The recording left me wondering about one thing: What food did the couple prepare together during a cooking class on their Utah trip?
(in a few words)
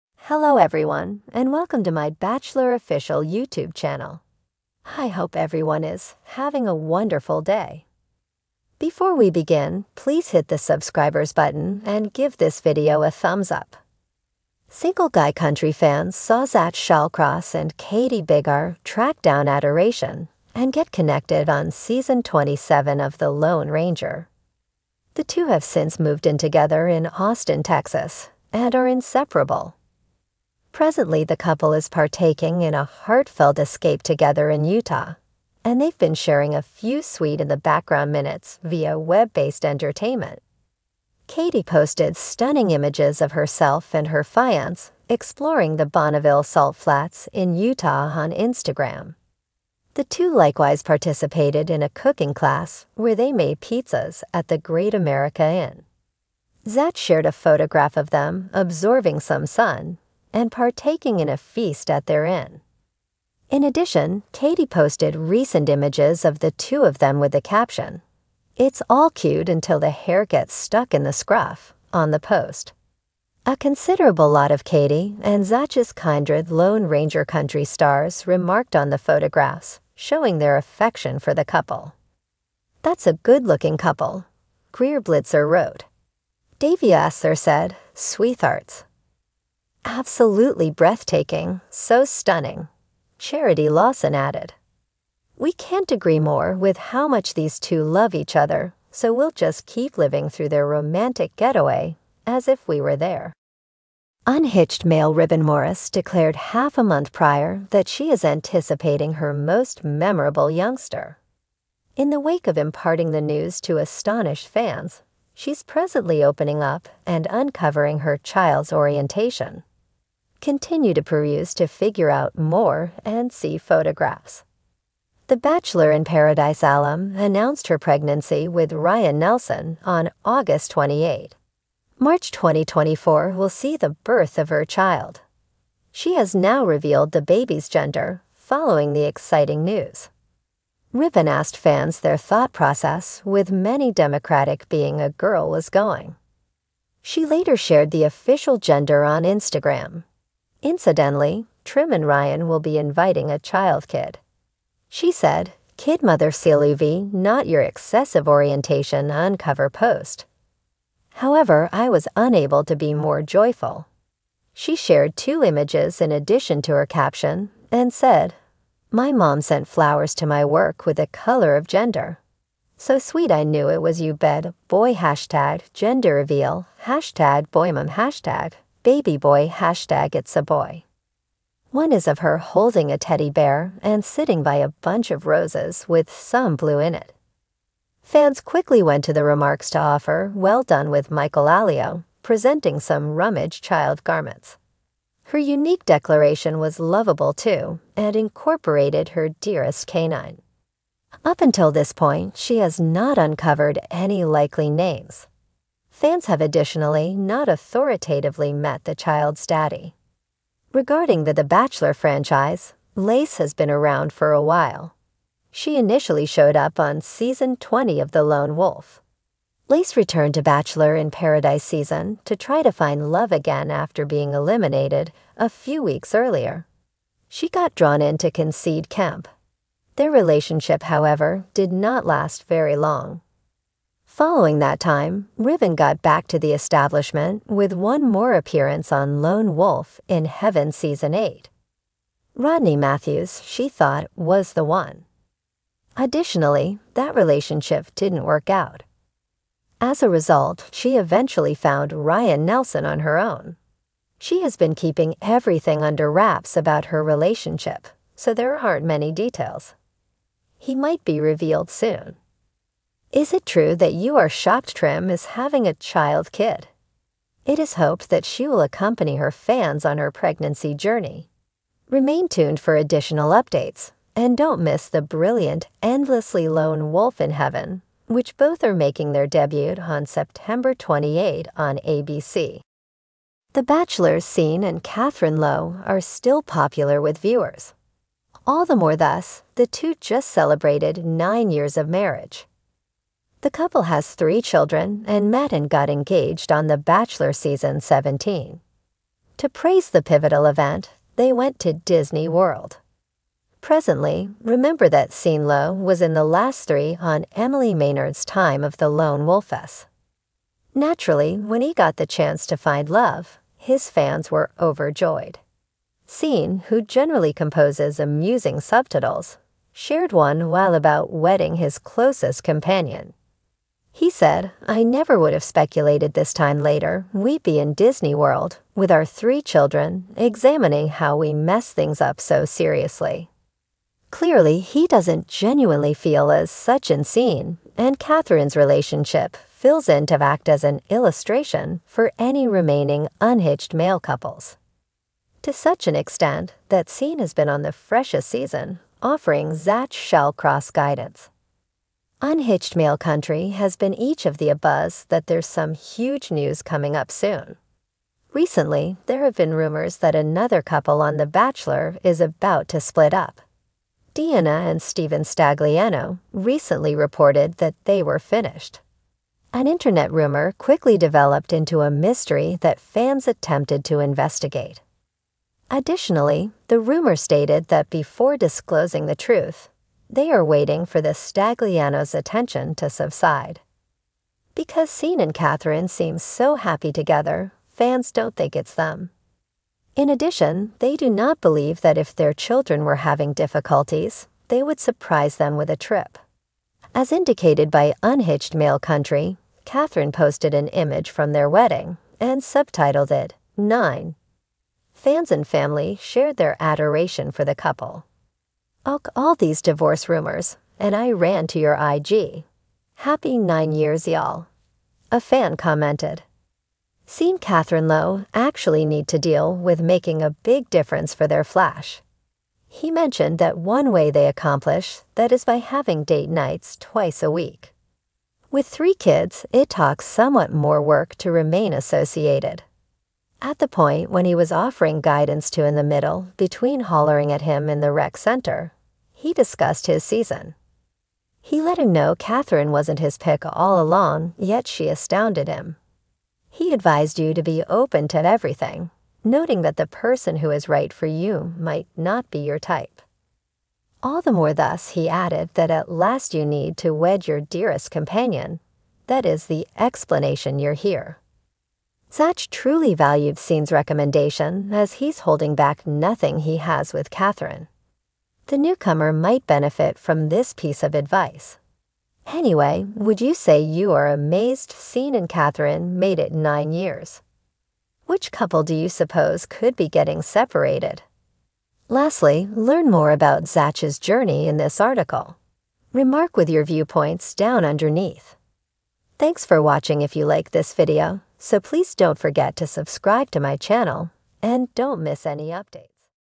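Pizzas.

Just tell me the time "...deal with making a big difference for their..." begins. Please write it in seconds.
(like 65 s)
419 s.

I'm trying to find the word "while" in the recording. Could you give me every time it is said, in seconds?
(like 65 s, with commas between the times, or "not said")
214 s, 320 s.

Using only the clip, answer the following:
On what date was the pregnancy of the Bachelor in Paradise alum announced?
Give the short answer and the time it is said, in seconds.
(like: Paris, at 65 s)
August 28, at 130 s.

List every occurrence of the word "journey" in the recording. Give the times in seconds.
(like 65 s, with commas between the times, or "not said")
270 s, 483 s.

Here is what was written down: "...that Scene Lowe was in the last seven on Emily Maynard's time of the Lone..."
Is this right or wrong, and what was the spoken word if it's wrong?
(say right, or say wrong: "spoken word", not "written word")
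wrong: "three", not "seven".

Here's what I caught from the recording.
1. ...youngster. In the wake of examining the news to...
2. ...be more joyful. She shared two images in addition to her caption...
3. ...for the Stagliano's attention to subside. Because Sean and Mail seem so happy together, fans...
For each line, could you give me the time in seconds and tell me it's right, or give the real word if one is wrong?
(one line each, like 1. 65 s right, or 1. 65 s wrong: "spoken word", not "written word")
1. 110 s wrong: "imparting", not "examining"
2. 162 s right
3. 380 s wrong: "Catherine", not "Mail".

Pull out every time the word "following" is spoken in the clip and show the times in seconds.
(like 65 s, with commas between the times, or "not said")
138 s, 234 s.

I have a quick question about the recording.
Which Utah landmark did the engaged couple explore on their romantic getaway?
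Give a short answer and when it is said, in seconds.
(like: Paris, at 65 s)
Bonneville Salt Flats, at 45 s.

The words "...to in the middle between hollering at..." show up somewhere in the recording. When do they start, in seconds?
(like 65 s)
435 s.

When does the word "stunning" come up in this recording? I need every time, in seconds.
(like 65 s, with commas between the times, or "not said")
42 s, 92 s.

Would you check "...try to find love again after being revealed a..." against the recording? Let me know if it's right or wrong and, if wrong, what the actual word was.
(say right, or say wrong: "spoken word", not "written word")
wrong: "eliminated", not "revealed".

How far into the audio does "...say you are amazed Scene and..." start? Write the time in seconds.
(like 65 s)
473 s.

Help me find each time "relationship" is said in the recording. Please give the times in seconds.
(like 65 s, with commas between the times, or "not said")
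230 s, 247 s, 257 s, 338 s.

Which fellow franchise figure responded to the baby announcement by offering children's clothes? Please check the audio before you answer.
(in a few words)
Michael Allio.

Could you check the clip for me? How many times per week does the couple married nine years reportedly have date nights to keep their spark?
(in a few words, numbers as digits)
2.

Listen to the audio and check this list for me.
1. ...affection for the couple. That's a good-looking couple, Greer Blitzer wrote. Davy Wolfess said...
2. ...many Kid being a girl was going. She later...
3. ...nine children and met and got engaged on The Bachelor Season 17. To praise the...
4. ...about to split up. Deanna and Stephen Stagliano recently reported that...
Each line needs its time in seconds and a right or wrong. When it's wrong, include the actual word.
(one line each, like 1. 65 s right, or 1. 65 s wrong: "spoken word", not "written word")
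1. 80 s wrong: "Asser", not "Wolfess"
2. 143 s wrong: "Democratic", not "Kid"
3. 294 s wrong: "three", not "nine"
4. 362 s right.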